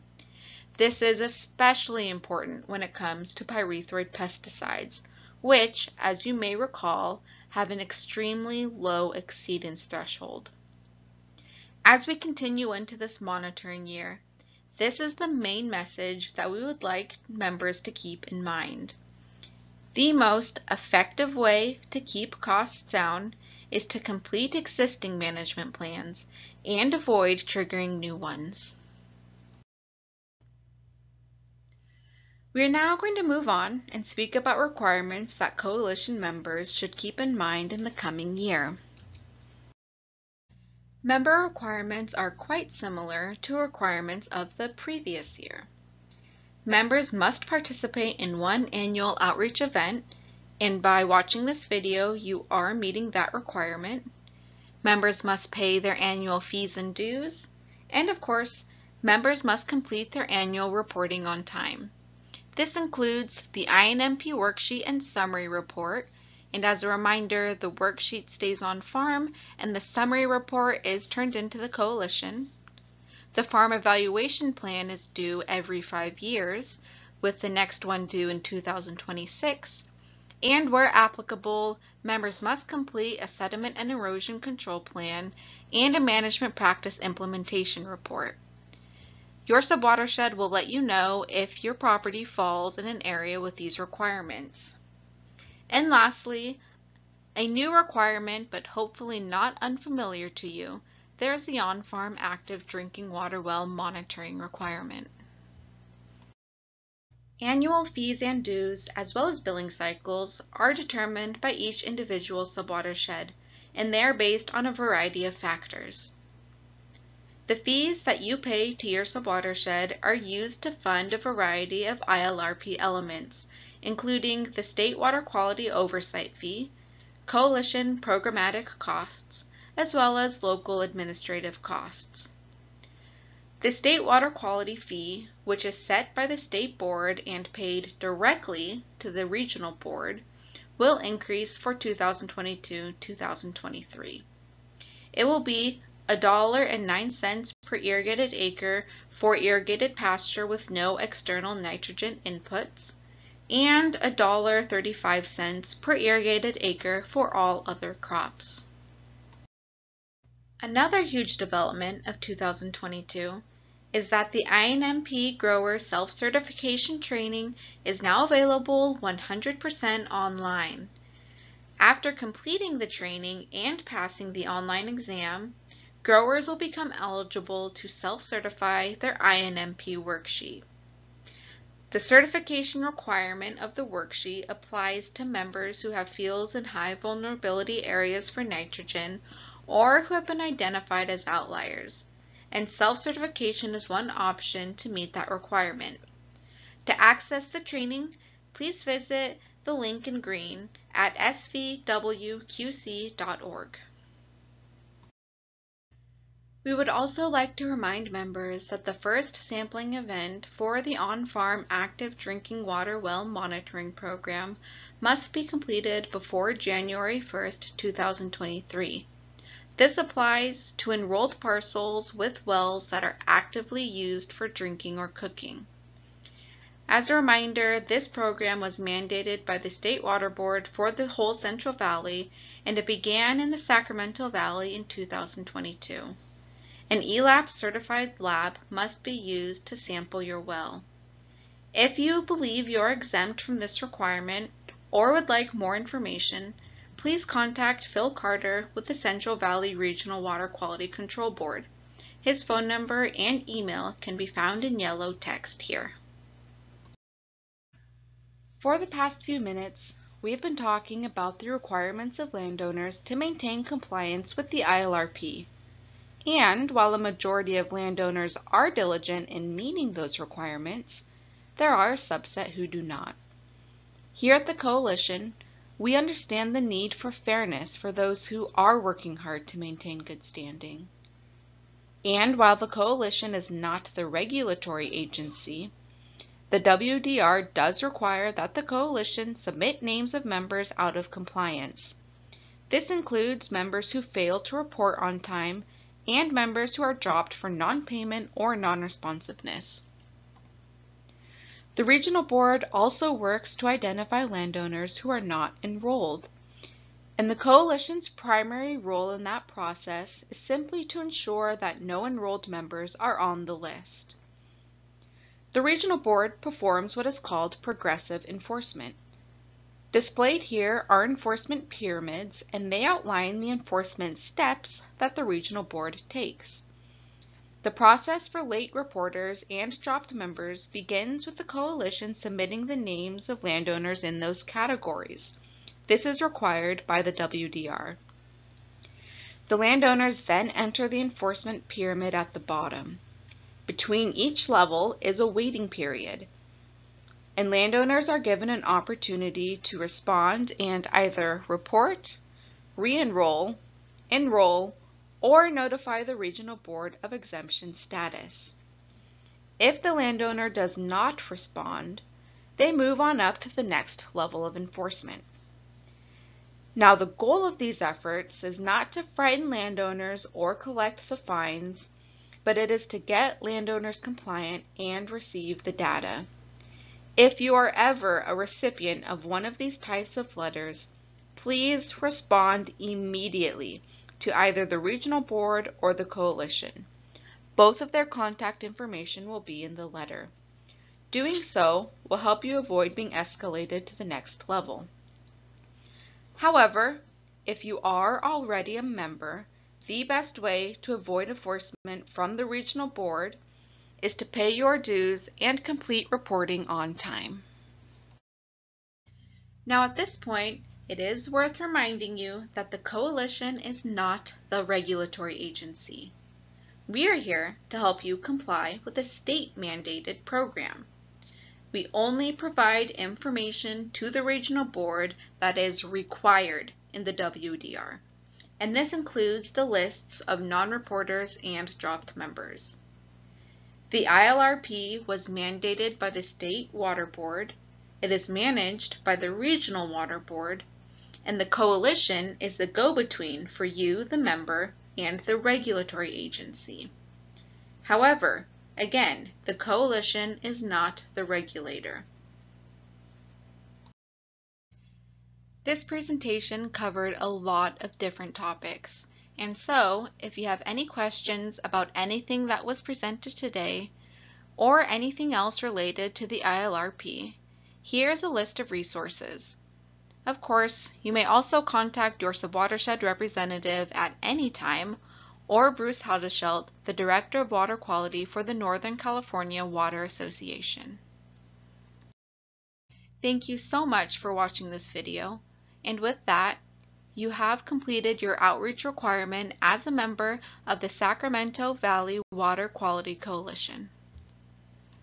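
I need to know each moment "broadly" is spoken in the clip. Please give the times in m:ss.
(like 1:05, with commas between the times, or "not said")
not said.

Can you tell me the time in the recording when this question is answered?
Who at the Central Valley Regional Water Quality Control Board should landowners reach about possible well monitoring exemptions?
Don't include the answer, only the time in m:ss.
4:07.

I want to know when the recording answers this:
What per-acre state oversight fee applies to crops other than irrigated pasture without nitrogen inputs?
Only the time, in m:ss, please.
2:33.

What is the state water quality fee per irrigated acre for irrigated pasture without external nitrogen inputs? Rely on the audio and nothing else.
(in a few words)
$1.09.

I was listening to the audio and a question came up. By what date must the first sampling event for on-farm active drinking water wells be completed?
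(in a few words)
January 1, 2023.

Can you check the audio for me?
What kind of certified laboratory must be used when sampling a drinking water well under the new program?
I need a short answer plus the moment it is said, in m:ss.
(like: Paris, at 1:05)
ELAP certified, at 3:57.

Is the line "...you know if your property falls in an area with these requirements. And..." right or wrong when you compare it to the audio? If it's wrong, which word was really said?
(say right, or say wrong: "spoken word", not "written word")
right.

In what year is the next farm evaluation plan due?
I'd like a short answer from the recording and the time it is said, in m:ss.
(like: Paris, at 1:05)
2026, at 1:18.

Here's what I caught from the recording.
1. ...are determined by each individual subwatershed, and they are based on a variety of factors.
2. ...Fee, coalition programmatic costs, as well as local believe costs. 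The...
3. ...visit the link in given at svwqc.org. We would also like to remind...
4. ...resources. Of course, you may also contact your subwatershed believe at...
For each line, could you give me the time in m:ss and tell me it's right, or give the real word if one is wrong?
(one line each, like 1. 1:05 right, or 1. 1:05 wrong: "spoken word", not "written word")
1. 1:50 right
2. 2:06 wrong: "administrative", not "believe"
3. 3:18 wrong: "green", not "given"
4. 7:48 wrong: "representative", not "believe".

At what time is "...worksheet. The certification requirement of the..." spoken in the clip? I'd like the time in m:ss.
2:59.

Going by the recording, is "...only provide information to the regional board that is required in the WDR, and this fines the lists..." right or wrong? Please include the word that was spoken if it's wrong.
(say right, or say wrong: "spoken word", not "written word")
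wrong: "includes", not "fines".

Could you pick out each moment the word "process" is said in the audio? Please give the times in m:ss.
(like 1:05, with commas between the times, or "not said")
5:09, 5:27.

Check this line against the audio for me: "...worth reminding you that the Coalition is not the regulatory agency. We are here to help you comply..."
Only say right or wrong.
right.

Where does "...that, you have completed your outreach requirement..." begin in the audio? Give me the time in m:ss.
8:06.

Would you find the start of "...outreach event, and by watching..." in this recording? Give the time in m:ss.
0:49.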